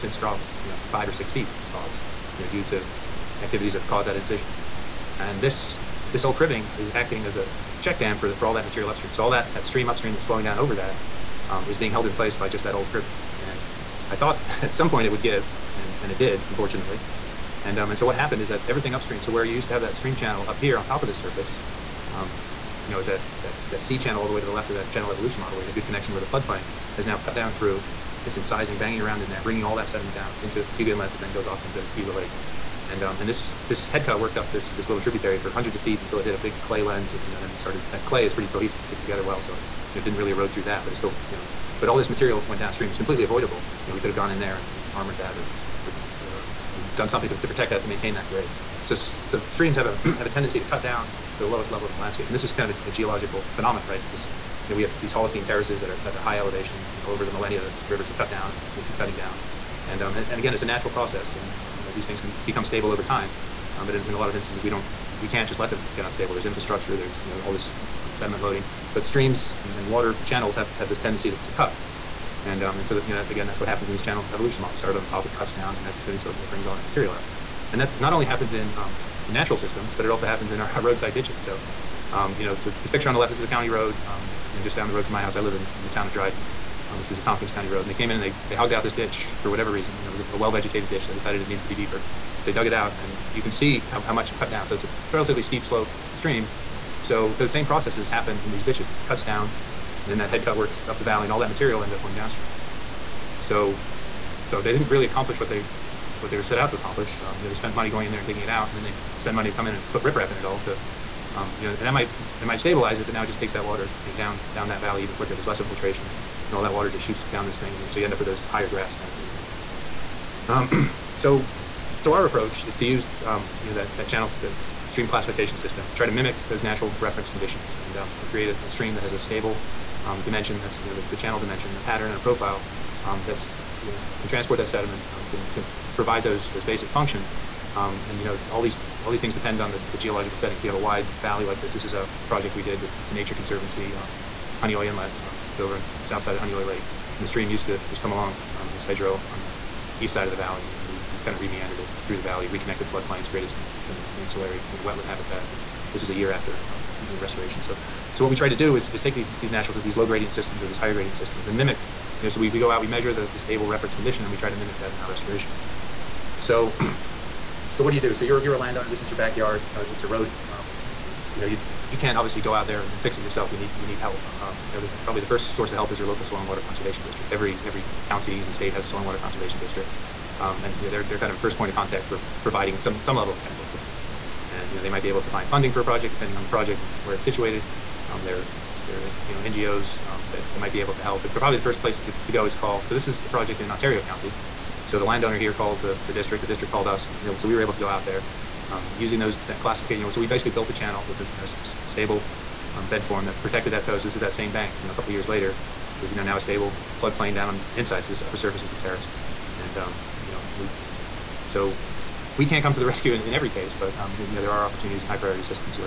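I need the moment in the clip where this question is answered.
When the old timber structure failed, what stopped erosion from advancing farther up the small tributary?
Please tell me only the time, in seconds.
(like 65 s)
36 s.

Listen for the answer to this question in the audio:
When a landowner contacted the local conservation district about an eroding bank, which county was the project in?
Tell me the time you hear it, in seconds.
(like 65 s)
193 s.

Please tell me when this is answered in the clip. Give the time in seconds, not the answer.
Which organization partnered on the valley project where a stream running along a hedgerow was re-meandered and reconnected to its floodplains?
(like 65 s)
143 s.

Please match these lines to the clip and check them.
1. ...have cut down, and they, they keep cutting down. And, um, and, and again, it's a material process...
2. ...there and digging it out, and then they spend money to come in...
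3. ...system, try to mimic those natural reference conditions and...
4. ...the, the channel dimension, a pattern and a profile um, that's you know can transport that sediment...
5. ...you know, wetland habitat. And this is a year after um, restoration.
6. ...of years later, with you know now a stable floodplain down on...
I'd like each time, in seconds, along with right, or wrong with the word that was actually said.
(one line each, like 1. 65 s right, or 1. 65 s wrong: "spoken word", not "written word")
1. 58 s wrong: "natural", not "material"
2. 108 s right
3. 125 s right
4. 130 s right
5. 154 s right
6. 205 s right.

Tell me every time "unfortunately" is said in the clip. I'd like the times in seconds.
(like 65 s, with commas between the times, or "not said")
16 s.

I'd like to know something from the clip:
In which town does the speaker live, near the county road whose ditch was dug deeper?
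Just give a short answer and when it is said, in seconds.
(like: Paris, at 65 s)
Dryden, at 85 s.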